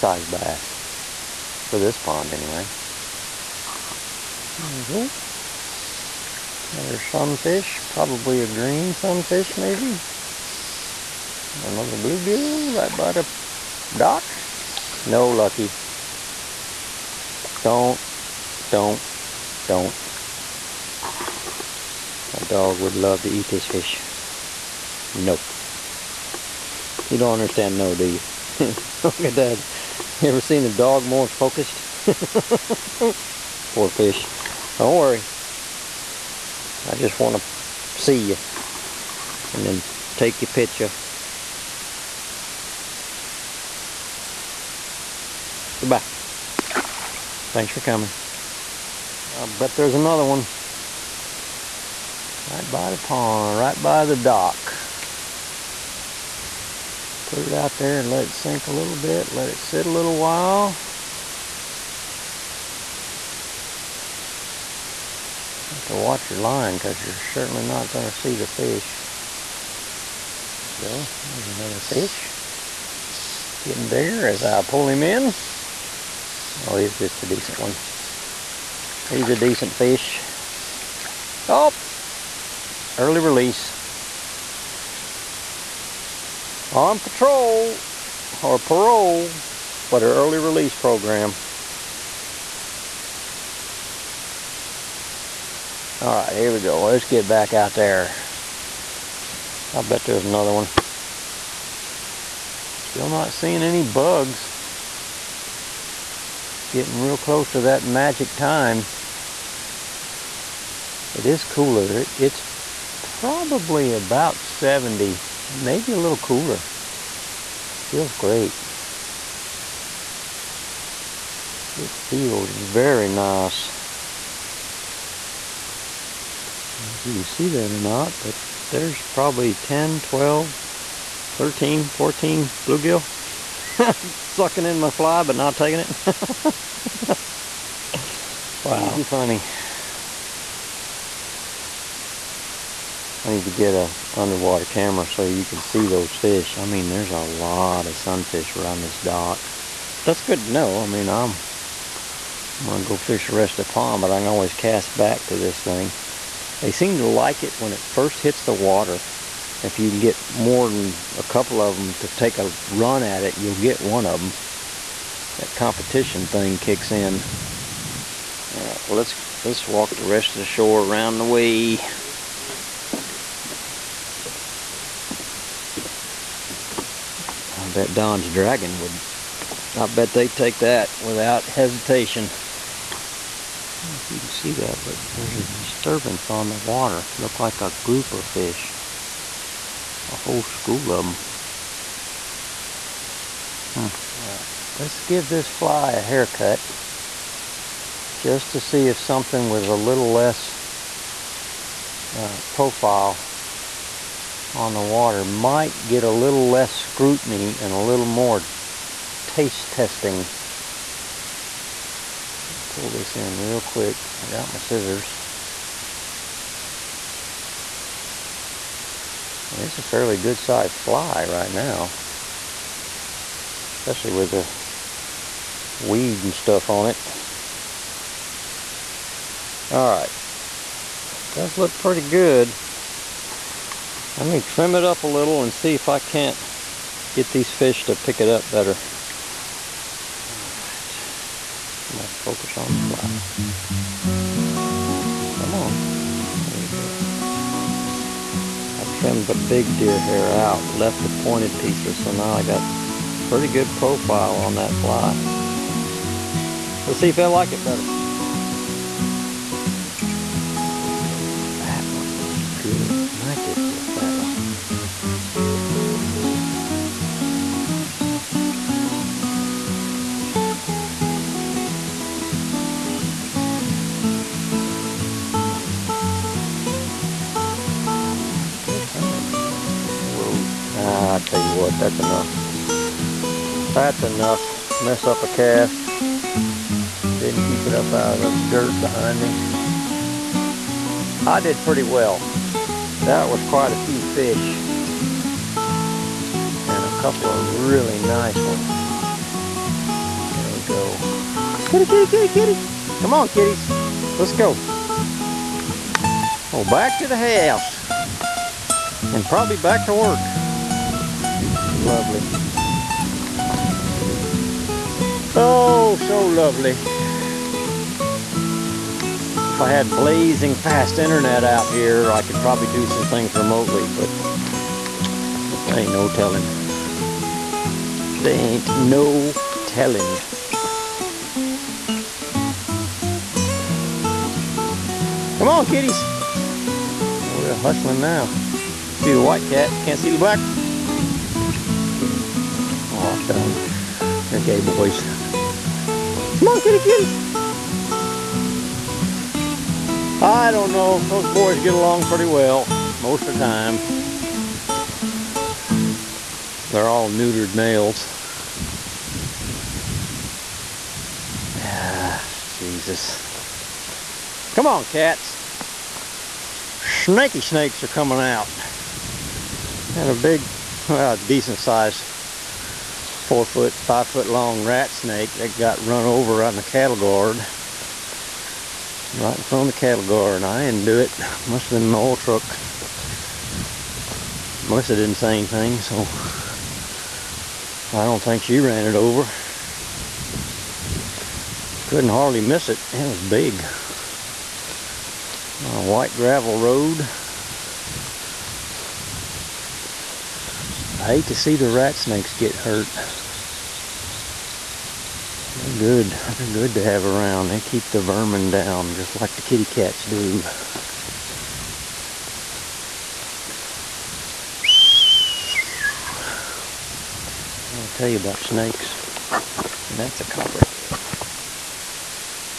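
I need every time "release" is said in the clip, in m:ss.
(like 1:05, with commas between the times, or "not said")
1:23, 1:30.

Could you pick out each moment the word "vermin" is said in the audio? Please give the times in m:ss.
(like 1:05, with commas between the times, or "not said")
6:48.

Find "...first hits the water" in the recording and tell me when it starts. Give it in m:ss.
2:37.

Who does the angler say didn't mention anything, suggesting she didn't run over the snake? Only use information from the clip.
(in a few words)
Melissa.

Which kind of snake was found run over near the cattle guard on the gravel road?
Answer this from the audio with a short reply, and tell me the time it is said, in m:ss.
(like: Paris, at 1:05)
rat snake, at 6:14.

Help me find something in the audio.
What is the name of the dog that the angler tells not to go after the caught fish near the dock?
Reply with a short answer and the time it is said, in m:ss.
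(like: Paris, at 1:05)
Lucky, at 0:15.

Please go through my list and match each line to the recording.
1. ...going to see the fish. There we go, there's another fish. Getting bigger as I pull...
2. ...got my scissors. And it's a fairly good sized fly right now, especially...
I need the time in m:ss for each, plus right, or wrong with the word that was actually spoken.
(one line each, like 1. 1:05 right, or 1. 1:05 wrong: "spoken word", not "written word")
1. 1:07 right
2. 3:34 right.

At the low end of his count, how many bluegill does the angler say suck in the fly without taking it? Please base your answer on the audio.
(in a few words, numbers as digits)
10.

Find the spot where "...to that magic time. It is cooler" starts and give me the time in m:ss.
1:47.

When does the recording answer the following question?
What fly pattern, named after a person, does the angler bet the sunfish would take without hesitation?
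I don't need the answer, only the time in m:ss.
2:57.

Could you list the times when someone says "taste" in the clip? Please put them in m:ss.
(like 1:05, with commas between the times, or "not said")
3:29.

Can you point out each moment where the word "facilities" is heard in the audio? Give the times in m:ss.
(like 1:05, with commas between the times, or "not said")
not said.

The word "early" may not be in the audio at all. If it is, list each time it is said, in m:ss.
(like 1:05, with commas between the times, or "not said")
1:22, 1:30.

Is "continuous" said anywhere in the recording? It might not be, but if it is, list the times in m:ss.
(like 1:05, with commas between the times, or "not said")
not said.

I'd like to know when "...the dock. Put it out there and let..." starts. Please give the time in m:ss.
0:54.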